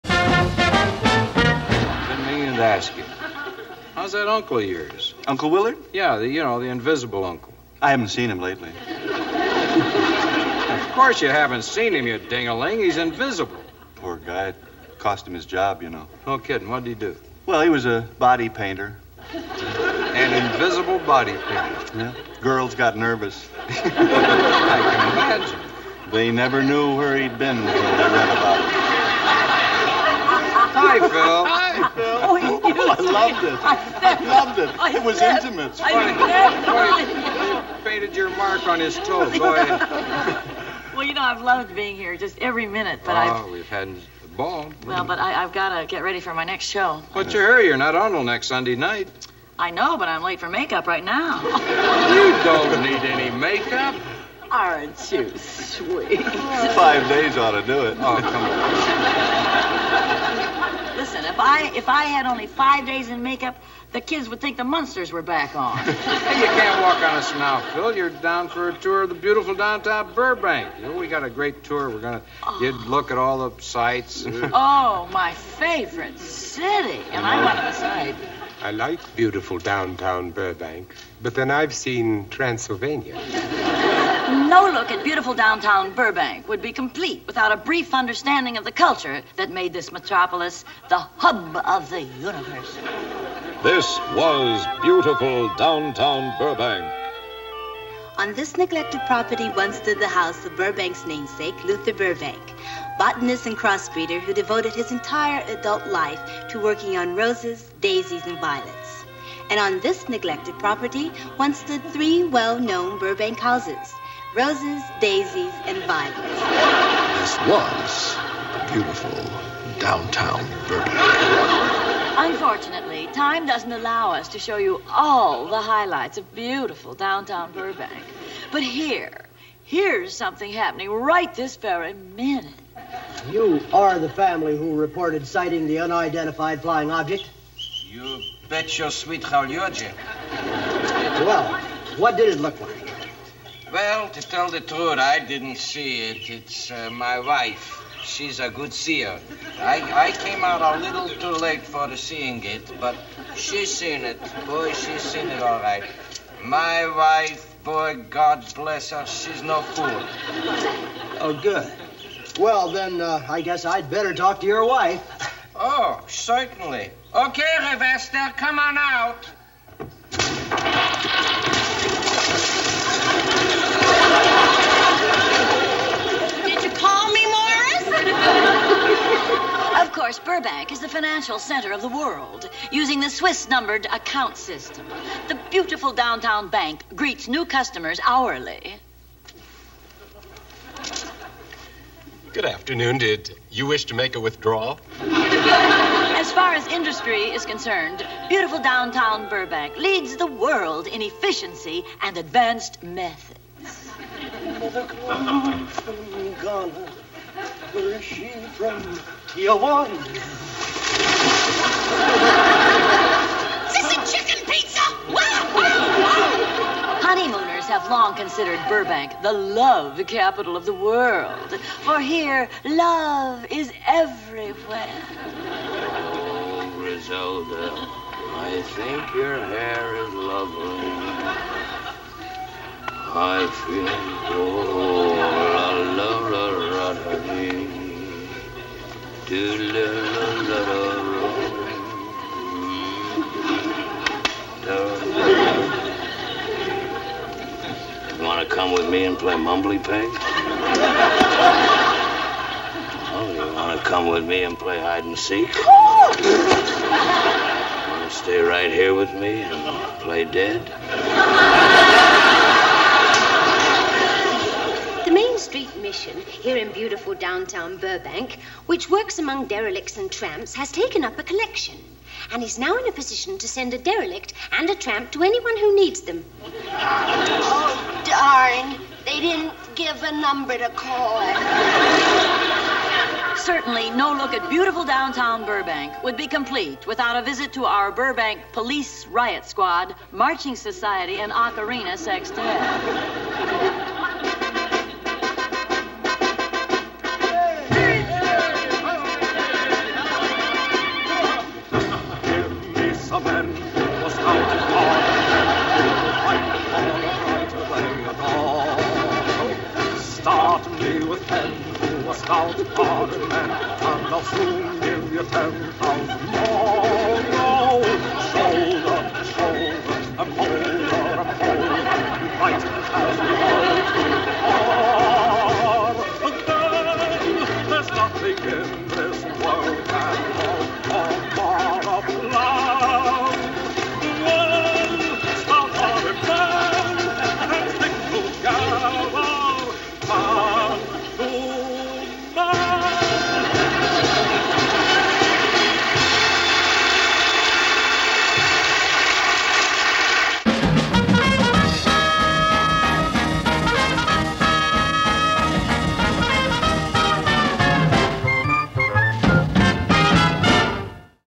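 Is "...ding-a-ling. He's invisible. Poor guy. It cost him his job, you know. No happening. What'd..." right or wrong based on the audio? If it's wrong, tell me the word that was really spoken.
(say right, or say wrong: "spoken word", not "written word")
wrong: "kidding", not "happening".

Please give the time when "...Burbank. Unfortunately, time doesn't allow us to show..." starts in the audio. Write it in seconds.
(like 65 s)
120 s.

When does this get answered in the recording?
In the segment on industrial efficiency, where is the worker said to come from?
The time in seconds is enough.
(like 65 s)
209 s.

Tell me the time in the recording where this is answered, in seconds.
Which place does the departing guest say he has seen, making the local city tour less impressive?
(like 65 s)
82 s.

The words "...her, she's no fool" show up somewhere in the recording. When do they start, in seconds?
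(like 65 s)
158 s.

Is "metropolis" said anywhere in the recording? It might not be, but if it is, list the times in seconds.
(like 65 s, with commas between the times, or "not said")
89 s.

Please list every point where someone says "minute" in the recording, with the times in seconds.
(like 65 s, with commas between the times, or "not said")
42 s, 131 s.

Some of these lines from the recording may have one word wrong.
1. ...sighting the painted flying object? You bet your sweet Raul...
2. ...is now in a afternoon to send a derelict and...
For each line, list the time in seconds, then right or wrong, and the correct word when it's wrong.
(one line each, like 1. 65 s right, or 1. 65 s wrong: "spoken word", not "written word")
1. 135 s wrong: "unidentified", not "painted"
2. 272 s wrong: "position", not "afternoon".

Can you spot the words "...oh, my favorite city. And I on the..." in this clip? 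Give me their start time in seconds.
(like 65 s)
74 s.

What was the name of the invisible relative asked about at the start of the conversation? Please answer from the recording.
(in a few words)
Uncle Willard.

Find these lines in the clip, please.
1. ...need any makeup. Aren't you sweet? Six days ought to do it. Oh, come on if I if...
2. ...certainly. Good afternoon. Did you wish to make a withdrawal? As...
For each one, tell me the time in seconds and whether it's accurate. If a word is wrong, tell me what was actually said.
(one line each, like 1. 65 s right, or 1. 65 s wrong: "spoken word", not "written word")
1. 52 s wrong: "Five", not "Six"
2. 188 s wrong: "hourly", not "certainly".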